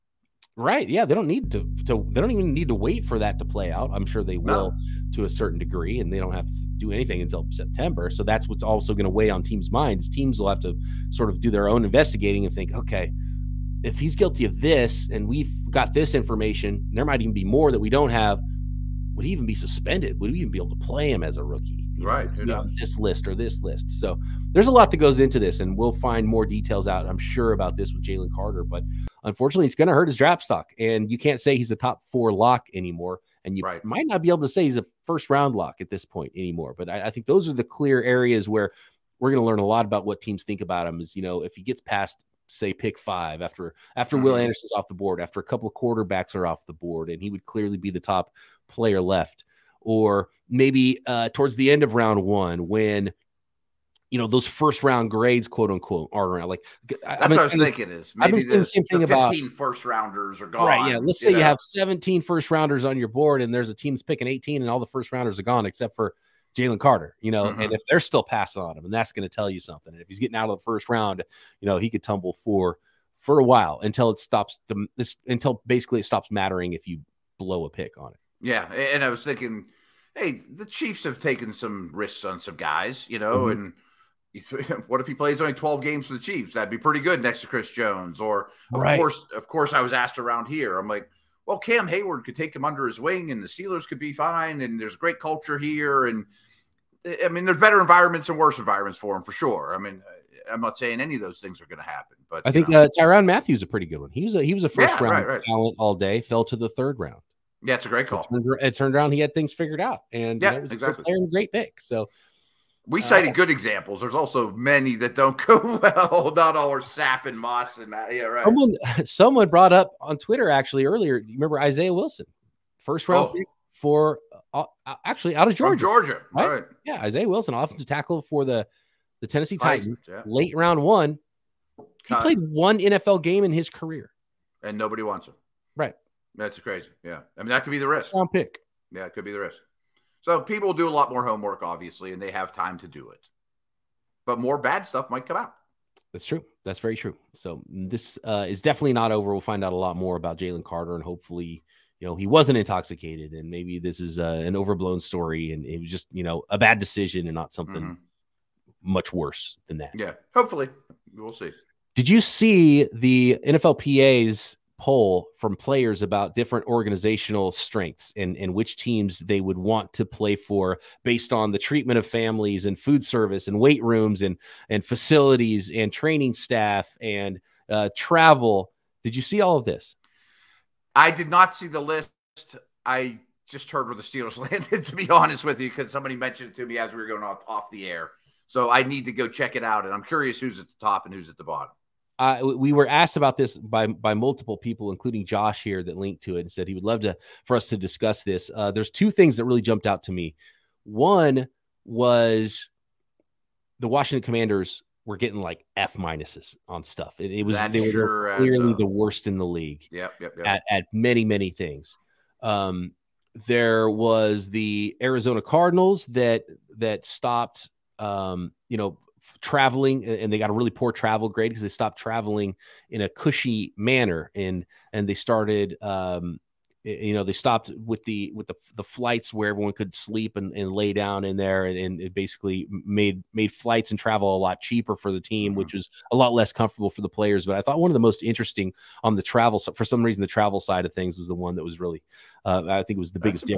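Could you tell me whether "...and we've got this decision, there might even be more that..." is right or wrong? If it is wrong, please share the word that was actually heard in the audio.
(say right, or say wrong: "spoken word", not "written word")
wrong: "information", not "decision".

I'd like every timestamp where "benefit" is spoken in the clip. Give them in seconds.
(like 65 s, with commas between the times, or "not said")
not said.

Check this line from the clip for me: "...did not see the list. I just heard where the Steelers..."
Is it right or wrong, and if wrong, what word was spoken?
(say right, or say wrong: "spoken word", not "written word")
right.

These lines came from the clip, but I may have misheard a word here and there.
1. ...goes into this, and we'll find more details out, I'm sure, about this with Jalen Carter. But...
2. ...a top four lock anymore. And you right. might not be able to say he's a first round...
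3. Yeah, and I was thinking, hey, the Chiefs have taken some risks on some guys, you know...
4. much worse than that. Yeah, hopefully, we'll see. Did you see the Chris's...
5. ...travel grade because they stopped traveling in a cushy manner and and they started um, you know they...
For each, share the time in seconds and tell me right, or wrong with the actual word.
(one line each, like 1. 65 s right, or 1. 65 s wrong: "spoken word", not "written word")
1. 24 s right
2. 31 s right
3. 78 s right
4. 158 s wrong: "NFLPA", not "Chris"
5. 220 s right.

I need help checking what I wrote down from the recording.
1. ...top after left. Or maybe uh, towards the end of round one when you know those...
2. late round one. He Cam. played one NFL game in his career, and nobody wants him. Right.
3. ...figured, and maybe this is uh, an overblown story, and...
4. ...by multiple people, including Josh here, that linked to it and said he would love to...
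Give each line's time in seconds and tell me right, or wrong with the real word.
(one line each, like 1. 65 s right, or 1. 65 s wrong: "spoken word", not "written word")
1. 47 s wrong: "player", not "after"
2. 130 s wrong: "Cut", not "Cam"
3. 152 s wrong: "intoxicated", not "figured"
4. 193 s right.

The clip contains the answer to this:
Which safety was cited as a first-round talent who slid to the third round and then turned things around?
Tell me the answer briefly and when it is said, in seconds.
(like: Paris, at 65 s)
Tyrann Mathieu, at 102 s.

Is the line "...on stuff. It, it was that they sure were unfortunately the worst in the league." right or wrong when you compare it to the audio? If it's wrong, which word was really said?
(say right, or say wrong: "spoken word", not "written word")
wrong: "clearly", not "unfortunately".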